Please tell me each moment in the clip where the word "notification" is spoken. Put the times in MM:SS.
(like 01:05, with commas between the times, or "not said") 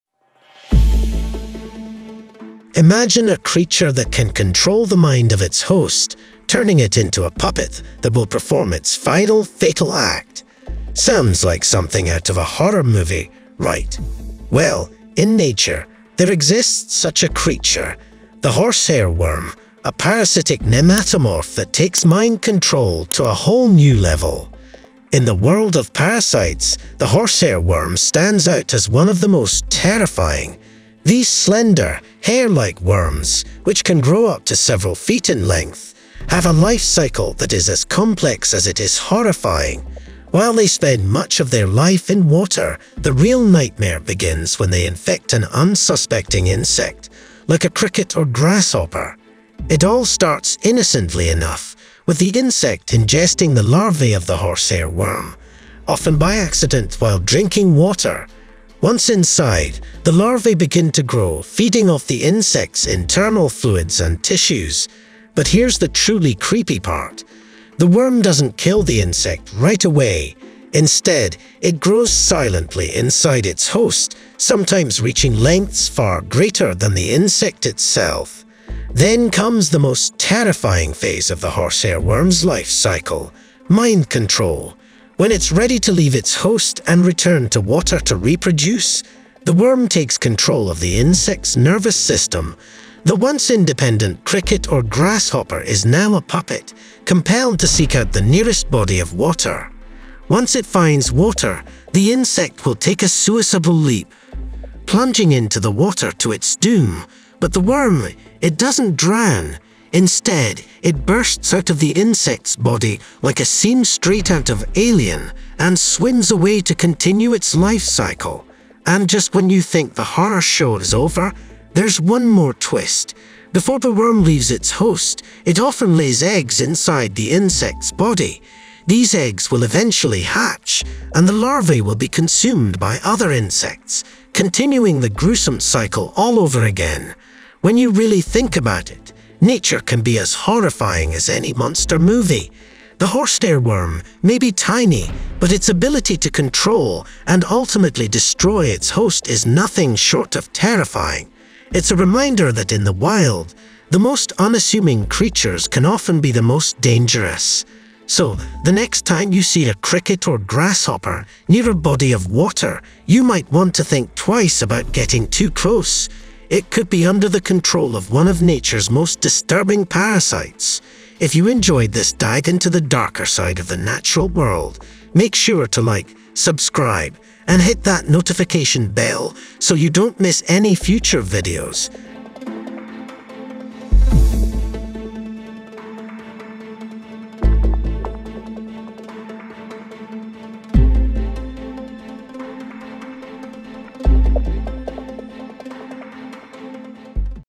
02:58.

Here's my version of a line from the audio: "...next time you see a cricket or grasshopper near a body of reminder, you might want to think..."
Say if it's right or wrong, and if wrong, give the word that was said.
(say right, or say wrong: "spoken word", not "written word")
wrong: "water", not "reminder".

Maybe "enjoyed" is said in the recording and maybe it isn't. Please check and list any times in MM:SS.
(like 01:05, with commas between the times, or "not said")
02:51.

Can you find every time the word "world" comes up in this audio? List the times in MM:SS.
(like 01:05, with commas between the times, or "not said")
00:25, 02:54.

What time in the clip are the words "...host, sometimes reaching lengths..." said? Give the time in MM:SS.
01:13.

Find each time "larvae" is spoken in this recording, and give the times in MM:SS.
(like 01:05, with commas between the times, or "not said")
00:53, 01:00, 02:11.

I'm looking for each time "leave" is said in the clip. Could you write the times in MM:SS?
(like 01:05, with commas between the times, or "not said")
01:25, 02:04.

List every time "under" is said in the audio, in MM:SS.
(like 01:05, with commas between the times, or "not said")
02:47.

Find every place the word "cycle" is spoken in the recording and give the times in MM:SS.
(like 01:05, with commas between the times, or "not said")
00:36, 01:22, 01:57, 02:15.